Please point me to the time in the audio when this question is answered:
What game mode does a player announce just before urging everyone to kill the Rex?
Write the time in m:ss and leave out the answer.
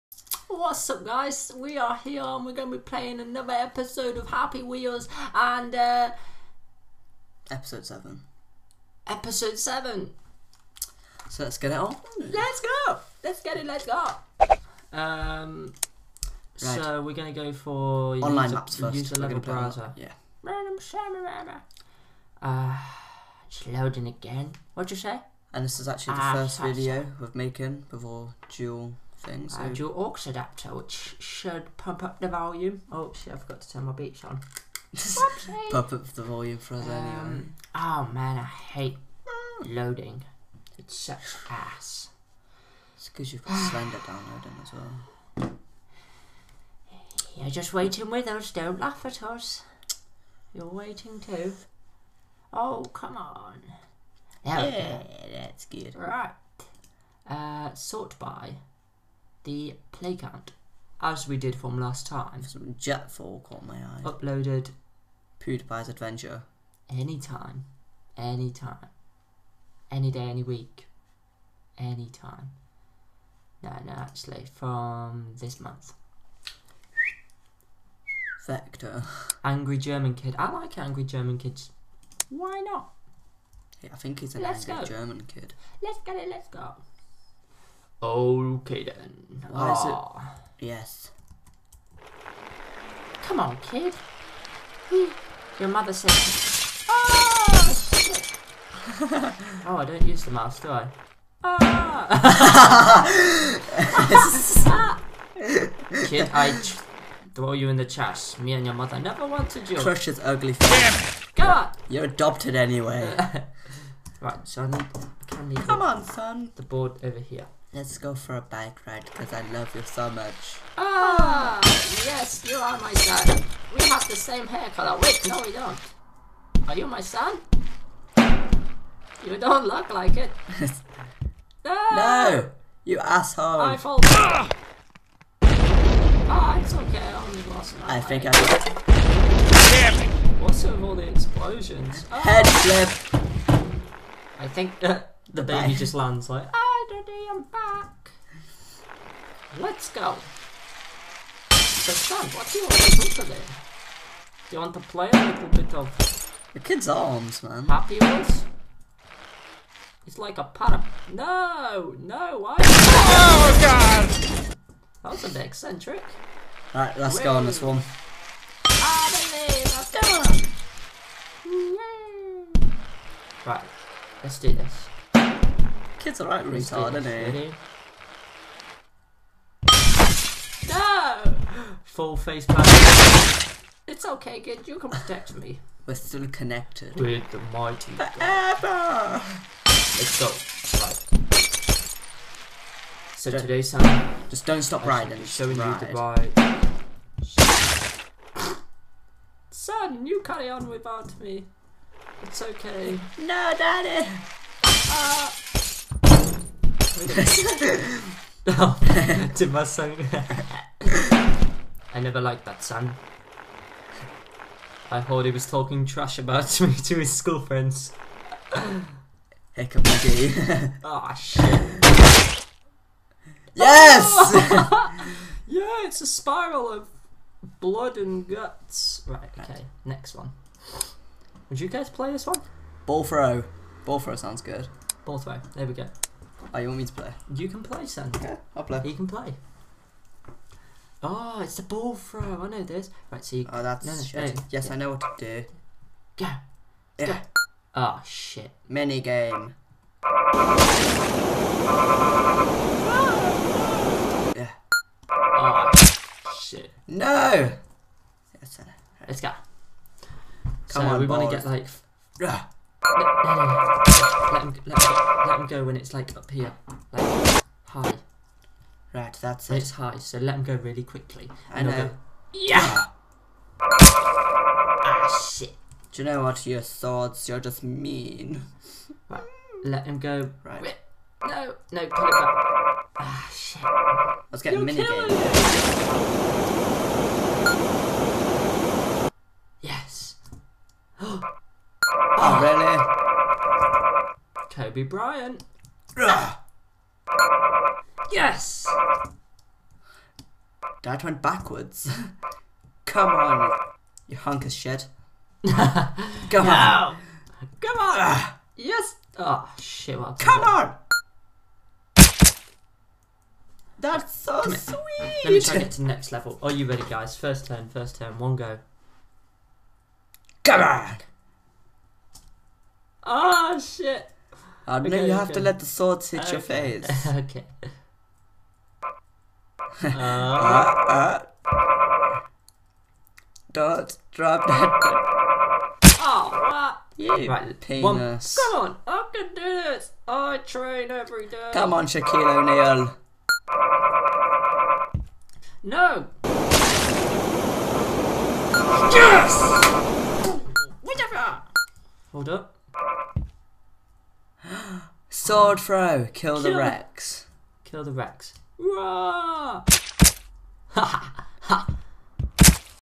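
5:55.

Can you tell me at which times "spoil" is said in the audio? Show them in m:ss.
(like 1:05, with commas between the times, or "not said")
not said.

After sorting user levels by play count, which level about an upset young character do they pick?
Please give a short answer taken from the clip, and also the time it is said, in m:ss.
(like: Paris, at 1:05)
Angry German Kid, at 1:19.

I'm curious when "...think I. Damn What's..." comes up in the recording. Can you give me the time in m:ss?
2:18.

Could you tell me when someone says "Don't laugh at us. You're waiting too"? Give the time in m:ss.
0:48.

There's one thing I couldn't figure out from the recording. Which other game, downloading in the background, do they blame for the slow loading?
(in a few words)
Slender.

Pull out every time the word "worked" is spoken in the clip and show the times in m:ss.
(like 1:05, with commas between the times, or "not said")
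not said.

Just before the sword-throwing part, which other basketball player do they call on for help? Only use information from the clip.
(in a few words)
Shaquille O'Neal.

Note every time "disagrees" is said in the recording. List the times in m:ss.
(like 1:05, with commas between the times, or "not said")
not said.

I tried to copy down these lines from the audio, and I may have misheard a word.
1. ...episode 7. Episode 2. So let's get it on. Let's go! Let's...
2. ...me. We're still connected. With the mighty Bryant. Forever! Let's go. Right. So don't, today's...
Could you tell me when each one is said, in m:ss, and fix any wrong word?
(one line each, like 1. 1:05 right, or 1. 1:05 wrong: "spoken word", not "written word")
1. 0:07 wrong: "7", not "2"
2. 3:05 wrong: "God", not "Bryant".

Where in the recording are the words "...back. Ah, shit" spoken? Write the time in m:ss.
4:42.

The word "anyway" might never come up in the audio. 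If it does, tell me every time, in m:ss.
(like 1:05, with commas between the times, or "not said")
0:37, 1:52.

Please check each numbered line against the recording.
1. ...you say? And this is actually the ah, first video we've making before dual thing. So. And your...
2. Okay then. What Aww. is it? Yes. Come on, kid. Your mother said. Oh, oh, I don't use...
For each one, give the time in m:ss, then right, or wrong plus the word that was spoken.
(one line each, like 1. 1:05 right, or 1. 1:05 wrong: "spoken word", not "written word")
1. 0:24 right
2. 1:28 right.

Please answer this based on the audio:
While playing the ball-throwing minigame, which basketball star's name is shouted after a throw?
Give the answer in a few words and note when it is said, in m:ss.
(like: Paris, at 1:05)
Kobe Bryant, at 4:54.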